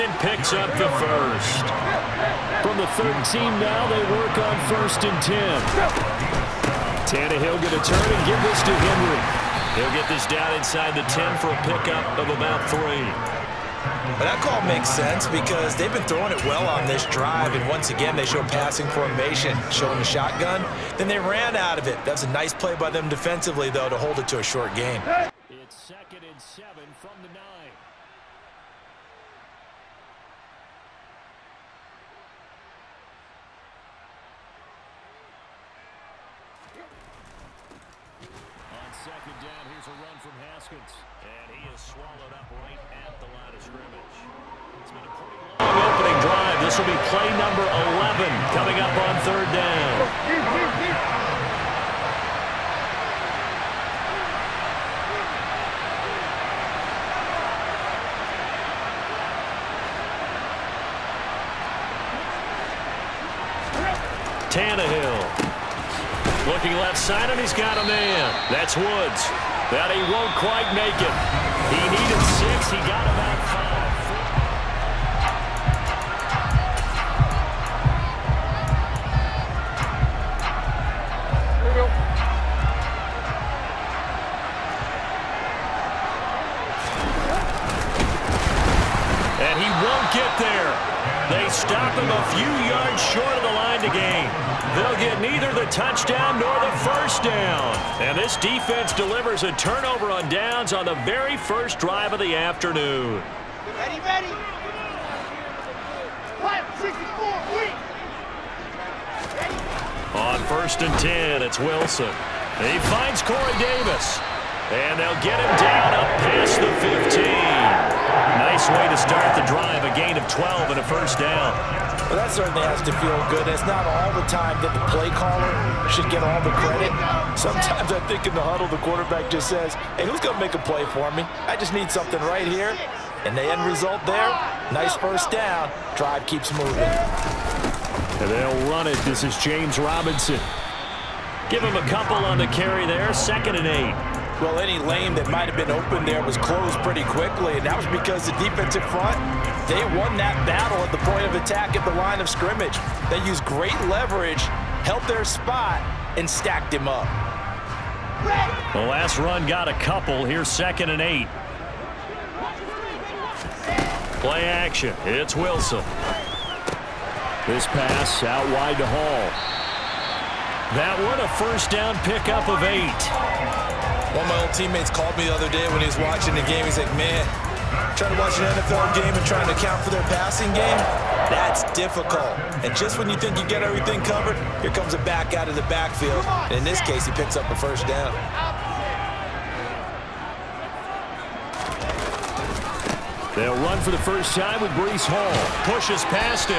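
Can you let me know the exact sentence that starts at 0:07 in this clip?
Tannehill going to turn and give this to Henry.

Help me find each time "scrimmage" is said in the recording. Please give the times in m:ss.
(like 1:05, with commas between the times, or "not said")
0:43, 2:32.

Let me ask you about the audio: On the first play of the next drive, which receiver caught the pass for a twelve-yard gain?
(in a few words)
Corey Davis.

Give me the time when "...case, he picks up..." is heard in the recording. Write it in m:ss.
3:06.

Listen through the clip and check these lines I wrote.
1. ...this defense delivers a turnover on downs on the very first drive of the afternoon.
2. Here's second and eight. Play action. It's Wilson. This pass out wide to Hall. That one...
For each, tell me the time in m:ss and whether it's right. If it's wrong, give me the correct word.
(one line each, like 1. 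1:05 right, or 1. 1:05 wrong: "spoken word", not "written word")
1. 1:38 right
2. 2:40 right.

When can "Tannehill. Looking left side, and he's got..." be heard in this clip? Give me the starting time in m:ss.
1:04.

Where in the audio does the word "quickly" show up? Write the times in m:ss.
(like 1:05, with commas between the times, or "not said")
2:27.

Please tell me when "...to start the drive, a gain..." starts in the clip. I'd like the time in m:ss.
1:58.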